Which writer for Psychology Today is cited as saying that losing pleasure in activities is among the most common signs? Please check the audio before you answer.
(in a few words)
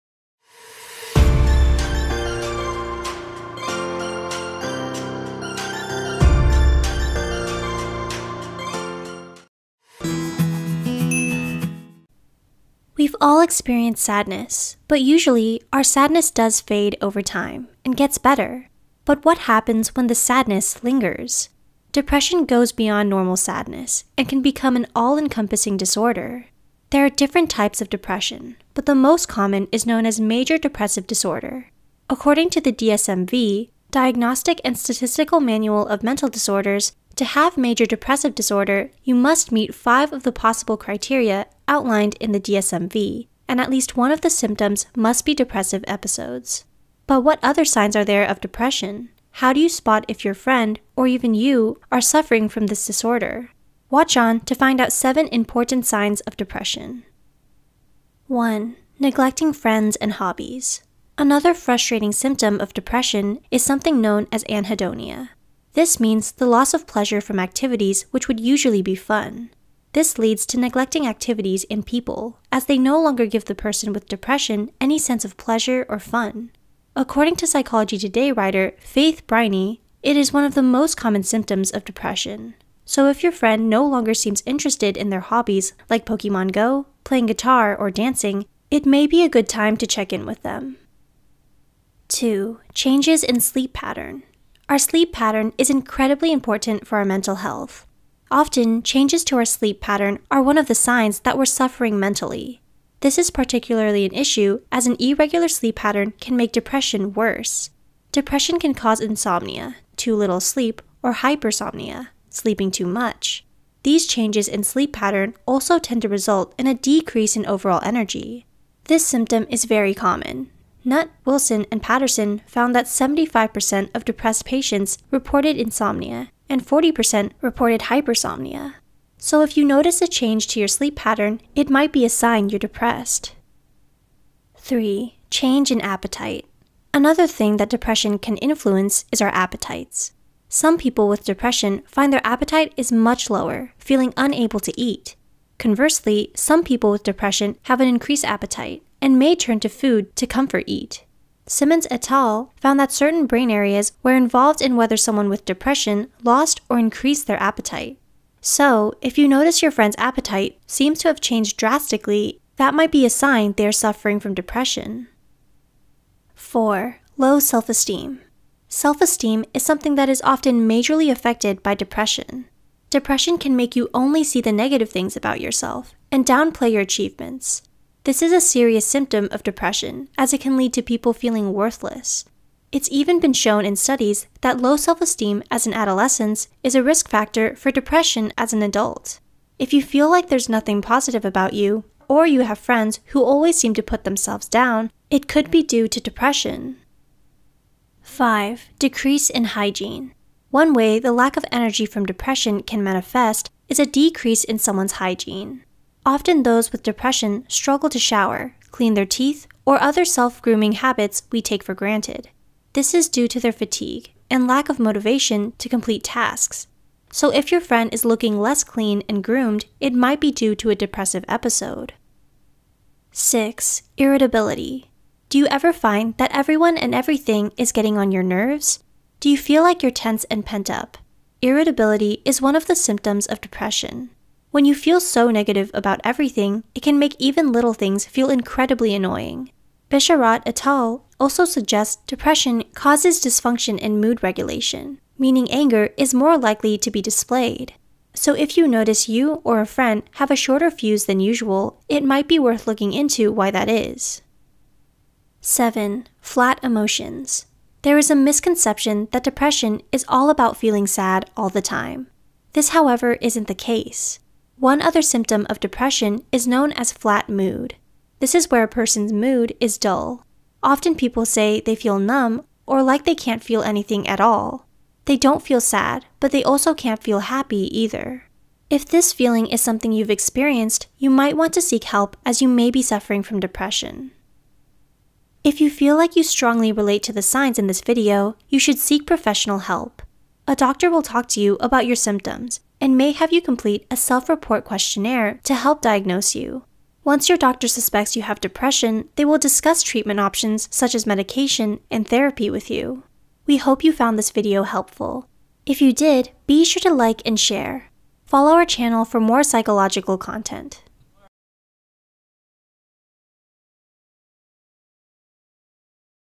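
Faith Brynie.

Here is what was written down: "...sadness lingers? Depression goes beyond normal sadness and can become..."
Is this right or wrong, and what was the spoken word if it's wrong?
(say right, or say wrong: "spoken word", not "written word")
right.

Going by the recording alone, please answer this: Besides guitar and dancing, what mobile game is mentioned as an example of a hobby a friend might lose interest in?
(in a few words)
Pokemon Go.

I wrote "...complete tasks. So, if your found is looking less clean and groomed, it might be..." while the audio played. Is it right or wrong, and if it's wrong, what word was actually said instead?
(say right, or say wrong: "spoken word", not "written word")
wrong: "friend", not "found".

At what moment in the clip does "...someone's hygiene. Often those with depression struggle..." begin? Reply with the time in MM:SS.
03:24.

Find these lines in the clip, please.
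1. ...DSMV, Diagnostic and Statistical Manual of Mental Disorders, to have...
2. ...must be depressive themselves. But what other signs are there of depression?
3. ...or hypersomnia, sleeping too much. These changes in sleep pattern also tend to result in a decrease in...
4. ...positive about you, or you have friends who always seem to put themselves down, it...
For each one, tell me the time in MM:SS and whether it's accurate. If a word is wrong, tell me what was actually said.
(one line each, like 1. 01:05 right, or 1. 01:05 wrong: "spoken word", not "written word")
1. 00:32 right
2. 00:44 wrong: "episodes", not "themselves"
3. 01:51 right
4. 03:10 right.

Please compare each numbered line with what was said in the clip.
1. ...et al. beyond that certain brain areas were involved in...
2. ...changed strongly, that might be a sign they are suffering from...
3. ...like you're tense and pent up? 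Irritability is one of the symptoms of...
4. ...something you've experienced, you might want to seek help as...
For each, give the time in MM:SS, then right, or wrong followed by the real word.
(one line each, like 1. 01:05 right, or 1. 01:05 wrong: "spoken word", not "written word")
1. 02:31 wrong: "found", not "beyond"
2. 02:41 wrong: "drastically", not "strongly"
3. 03:49 right
4. 04:39 right.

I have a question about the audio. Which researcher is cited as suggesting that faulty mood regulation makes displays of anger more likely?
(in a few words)
Bisharat.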